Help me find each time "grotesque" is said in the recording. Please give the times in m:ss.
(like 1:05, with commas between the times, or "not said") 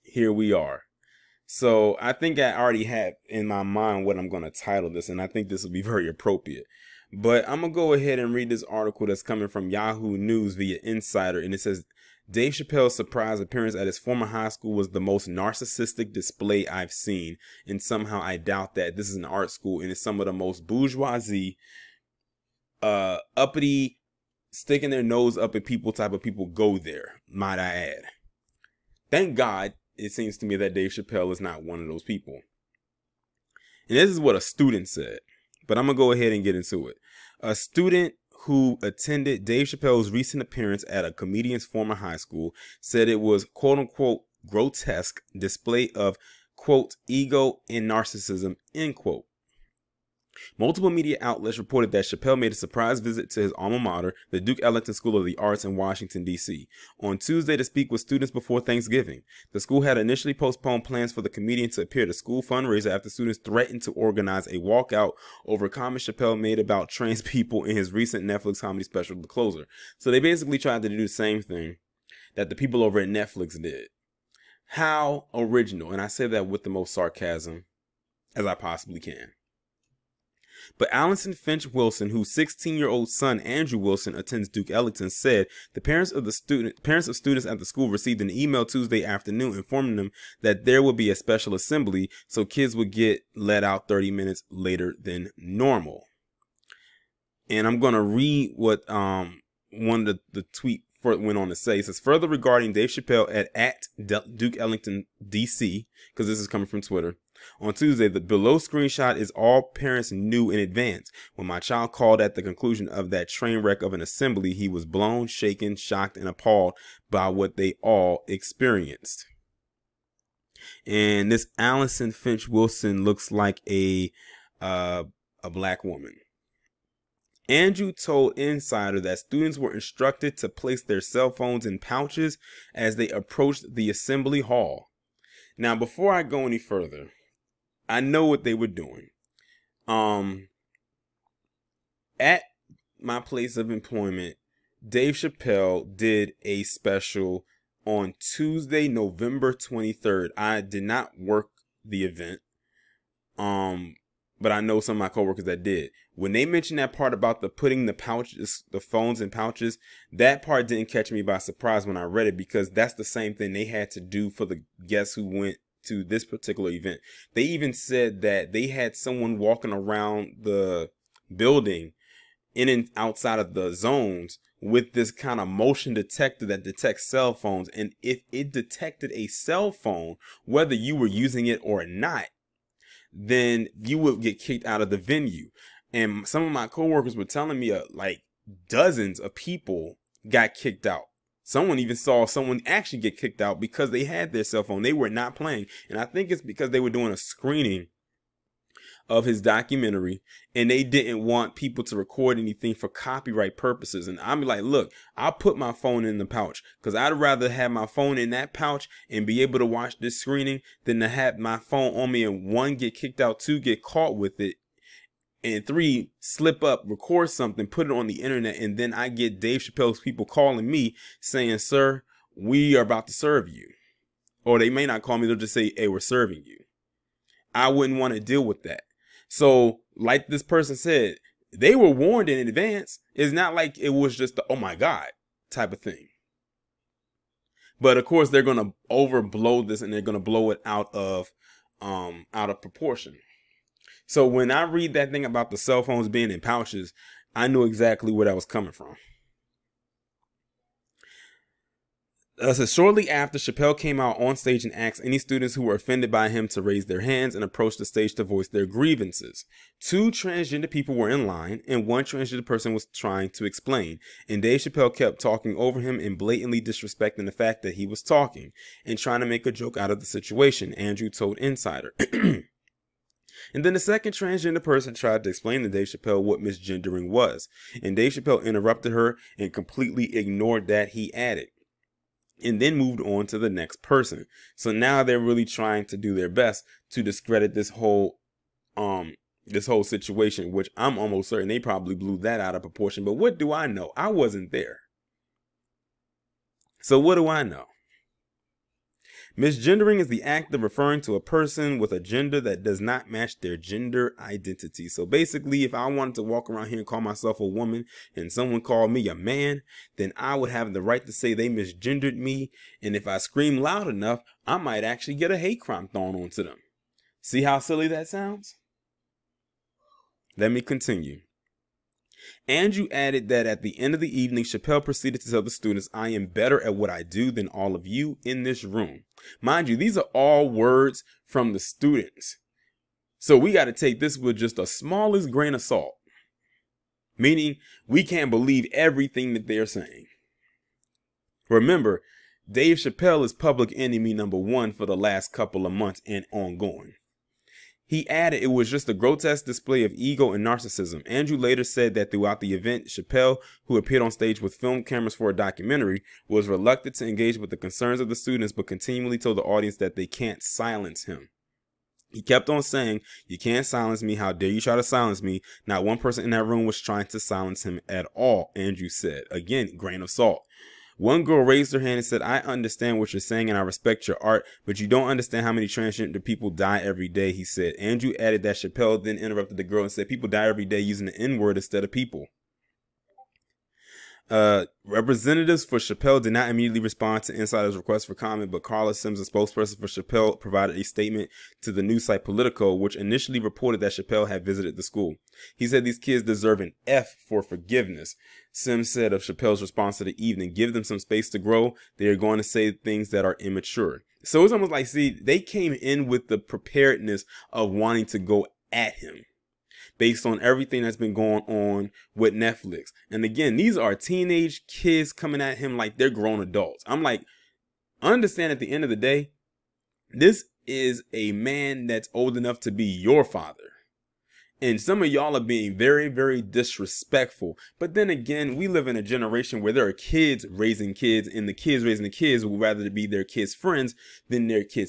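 0:44, 5:48.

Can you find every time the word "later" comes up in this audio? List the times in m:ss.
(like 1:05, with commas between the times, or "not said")
1:34, 5:51.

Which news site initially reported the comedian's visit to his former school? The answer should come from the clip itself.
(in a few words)
Politico.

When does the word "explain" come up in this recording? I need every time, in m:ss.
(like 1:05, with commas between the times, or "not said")
4:23, 4:35.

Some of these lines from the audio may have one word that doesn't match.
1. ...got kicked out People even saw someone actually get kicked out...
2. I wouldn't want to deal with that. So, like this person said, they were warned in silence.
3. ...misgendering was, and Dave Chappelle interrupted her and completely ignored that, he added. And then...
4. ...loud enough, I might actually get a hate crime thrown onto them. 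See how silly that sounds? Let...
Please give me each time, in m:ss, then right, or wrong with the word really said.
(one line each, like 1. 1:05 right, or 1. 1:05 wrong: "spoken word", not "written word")
1. 3:10 wrong: "Someone", not "People"
2. 3:47 wrong: "advance", not "silence"
3. 4:36 right
4. 5:13 right.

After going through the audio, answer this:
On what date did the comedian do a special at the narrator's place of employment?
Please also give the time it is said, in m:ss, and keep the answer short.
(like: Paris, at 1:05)
November 23rd, at 2:28.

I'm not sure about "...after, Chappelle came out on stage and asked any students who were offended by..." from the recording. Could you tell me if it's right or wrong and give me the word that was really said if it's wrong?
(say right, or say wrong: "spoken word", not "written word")
right.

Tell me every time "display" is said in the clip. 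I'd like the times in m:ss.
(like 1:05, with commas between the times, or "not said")
0:16, 0:45, 5:49.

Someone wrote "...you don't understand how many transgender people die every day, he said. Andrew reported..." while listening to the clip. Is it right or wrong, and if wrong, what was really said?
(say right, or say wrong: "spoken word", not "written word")
wrong: "added", not "reported".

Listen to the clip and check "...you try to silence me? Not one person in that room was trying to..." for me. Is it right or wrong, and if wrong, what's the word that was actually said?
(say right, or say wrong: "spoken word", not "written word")
right.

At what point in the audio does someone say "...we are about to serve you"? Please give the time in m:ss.
3:42.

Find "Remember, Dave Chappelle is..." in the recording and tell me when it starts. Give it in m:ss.
5:41.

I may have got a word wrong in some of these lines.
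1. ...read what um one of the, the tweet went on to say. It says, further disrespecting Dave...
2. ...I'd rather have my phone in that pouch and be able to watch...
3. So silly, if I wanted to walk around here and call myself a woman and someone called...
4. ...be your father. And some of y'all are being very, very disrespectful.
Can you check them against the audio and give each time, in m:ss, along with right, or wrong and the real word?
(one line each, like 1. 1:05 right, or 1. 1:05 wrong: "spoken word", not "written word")
1. 1:38 wrong: "regarding", not "disrespecting"
2. 3:26 right
3. 5:04 wrong: "basically", not "silly"
4. 7:02 right.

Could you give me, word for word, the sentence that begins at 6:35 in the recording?
He said these kids deserve an F for forgiveness.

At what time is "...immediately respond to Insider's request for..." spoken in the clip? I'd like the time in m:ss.
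6:26.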